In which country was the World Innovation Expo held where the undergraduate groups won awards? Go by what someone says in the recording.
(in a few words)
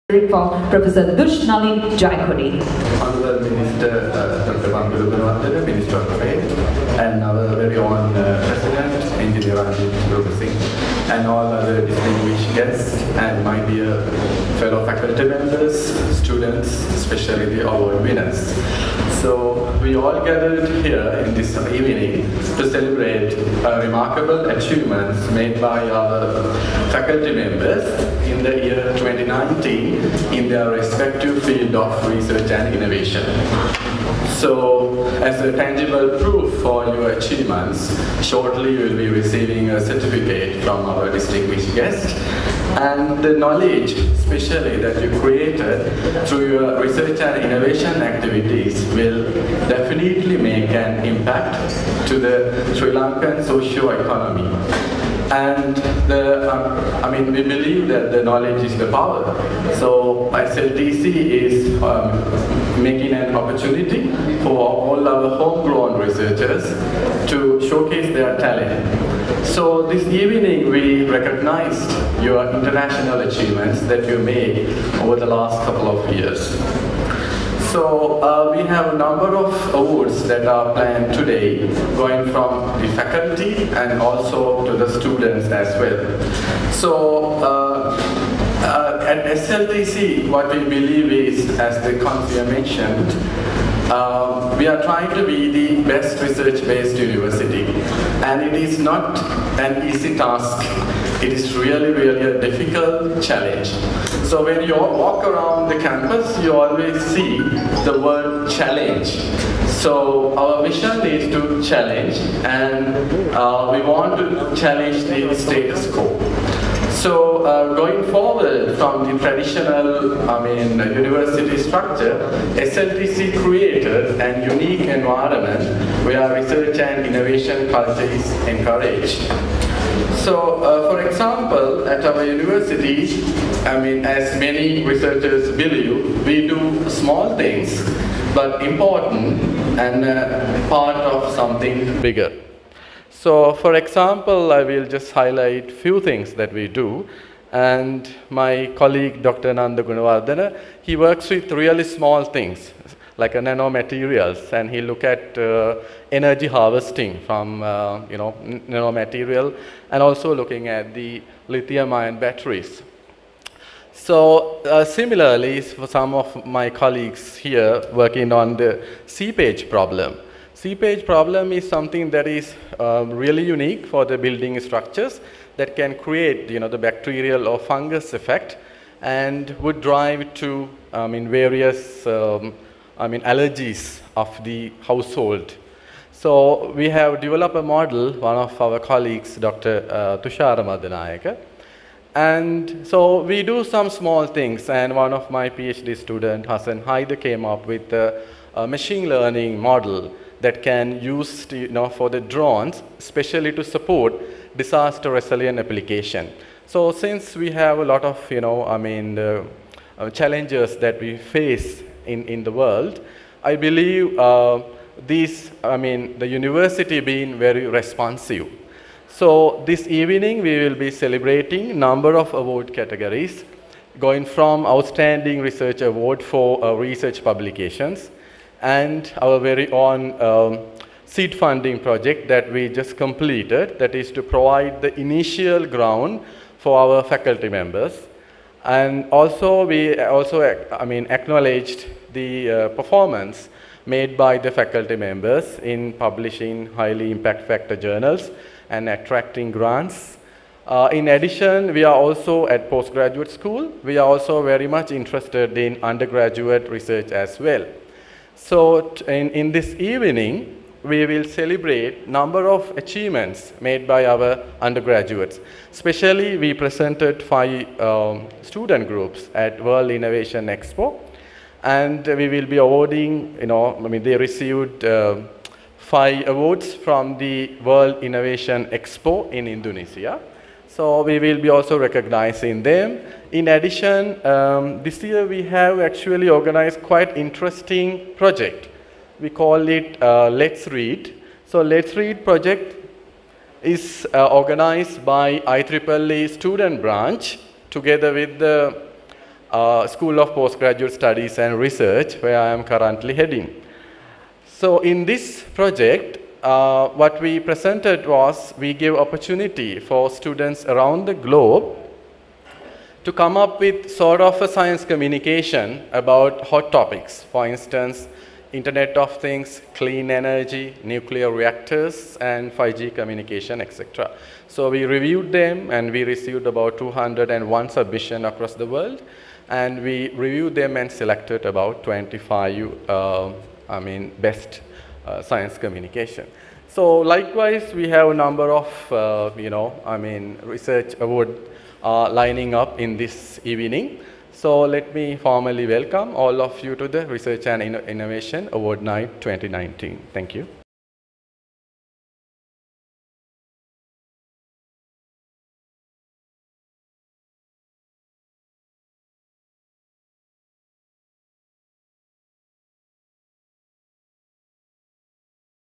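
Indonesia.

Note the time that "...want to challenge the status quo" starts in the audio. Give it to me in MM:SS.
01:53.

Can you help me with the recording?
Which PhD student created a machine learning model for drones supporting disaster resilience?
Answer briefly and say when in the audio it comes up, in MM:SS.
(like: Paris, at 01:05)
Hassan Haider, at 03:16.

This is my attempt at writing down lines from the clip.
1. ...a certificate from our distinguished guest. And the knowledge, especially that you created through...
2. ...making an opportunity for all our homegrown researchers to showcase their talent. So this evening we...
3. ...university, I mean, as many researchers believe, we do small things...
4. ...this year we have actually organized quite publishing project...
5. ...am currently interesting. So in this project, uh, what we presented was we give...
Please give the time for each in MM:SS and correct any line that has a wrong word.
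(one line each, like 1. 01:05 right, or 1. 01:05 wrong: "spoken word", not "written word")
1. 00:39 right
2. 01:02 right
3. 02:12 right
4. 04:44 wrong: "interesting", not "publishing"
5. 05:02 wrong: "heading", not "interesting".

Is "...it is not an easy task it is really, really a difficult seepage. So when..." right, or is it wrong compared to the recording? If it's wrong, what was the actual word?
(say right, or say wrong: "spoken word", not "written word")
wrong: "challenge", not "seepage".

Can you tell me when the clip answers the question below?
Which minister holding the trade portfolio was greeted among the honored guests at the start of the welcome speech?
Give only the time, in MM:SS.
00:04.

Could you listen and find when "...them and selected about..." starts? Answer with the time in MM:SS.
05:30.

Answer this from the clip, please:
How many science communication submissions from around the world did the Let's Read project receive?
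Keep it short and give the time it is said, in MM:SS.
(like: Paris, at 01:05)
201, at 05:26.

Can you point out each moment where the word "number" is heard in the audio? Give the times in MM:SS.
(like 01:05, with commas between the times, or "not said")
01:18, 03:41, 04:22, 05:38.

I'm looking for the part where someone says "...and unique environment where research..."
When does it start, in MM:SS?
02:04.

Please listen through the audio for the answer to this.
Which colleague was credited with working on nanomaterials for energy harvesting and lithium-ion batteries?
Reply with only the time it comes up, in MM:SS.
02:29.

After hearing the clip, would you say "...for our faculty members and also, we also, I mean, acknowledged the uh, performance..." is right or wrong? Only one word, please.
right.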